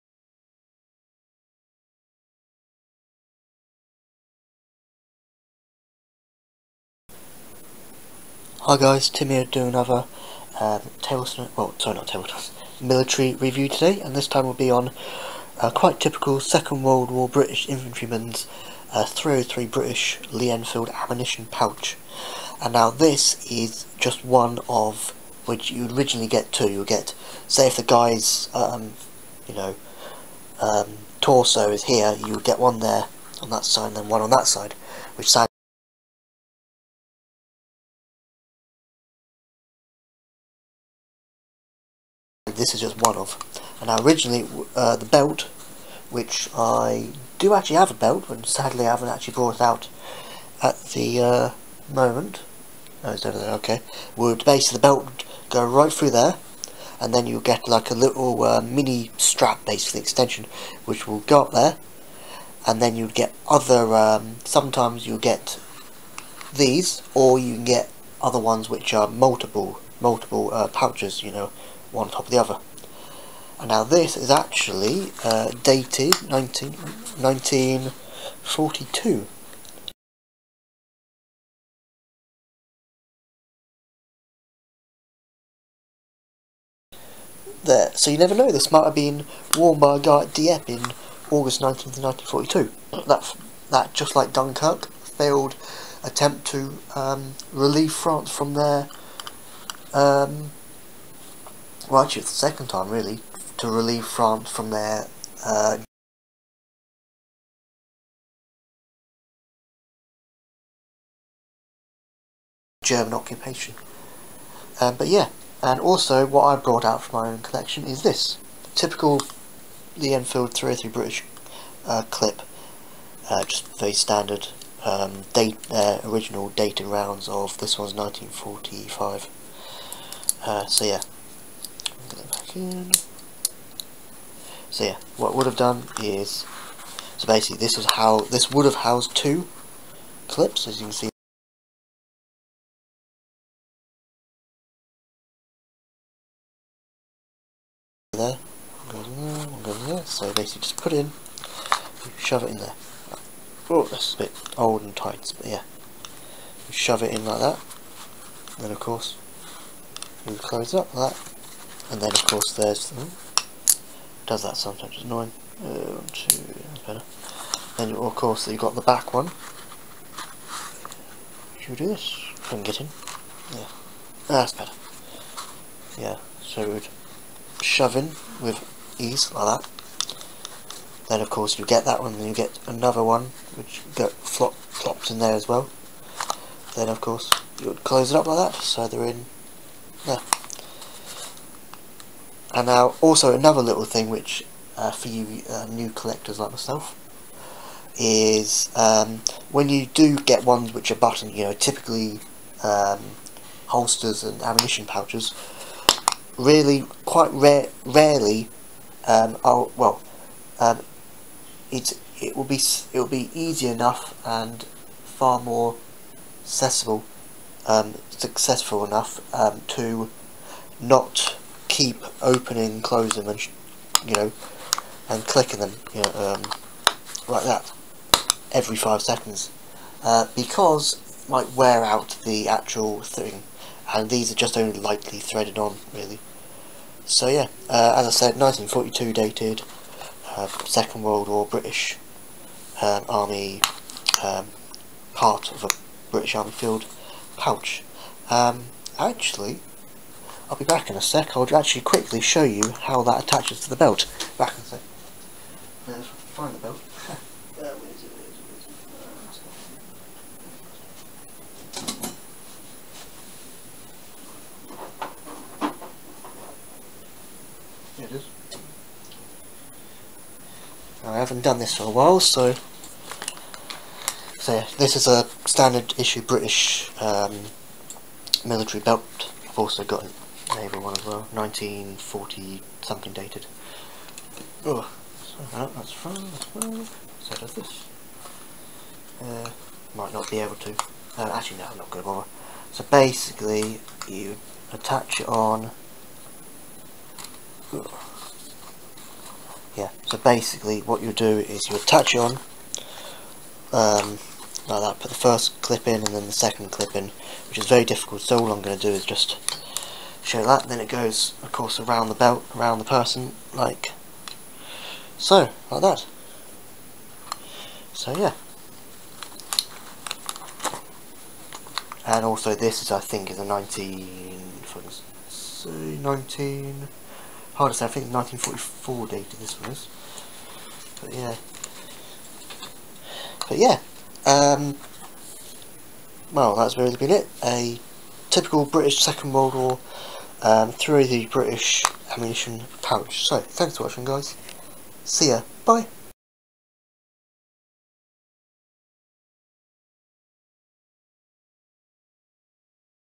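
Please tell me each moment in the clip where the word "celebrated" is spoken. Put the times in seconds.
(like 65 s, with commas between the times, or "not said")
not said.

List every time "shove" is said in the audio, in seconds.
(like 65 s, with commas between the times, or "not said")
152 s, 156 s, 177 s.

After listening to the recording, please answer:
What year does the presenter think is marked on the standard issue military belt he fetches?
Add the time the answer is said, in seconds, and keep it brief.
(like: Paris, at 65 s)
1944, at 328 s.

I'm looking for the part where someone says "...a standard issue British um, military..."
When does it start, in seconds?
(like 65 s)
275 s.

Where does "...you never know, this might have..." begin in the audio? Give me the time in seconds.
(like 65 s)
88 s.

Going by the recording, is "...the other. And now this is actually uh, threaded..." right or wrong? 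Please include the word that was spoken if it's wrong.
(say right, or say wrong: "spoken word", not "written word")
wrong: "dated", not "threaded".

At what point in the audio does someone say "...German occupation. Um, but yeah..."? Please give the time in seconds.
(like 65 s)
112 s.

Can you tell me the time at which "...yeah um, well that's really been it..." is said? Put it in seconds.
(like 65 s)
333 s.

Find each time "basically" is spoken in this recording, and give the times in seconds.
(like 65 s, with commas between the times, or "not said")
54 s, 59 s, 137 s, 150 s, 292 s, 300 s.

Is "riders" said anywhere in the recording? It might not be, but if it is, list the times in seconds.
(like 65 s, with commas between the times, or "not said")
not said.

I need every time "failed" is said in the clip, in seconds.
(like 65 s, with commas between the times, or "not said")
94 s.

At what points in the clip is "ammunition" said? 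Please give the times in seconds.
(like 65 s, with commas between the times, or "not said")
20 s, 204 s, 342 s.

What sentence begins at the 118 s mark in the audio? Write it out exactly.
Typical the Enfield 303 British uh, clip.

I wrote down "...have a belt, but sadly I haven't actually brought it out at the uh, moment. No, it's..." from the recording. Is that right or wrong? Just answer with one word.
right.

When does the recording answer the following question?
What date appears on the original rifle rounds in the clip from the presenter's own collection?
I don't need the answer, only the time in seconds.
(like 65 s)
127 s.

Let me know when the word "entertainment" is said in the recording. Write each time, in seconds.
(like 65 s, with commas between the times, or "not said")
not said.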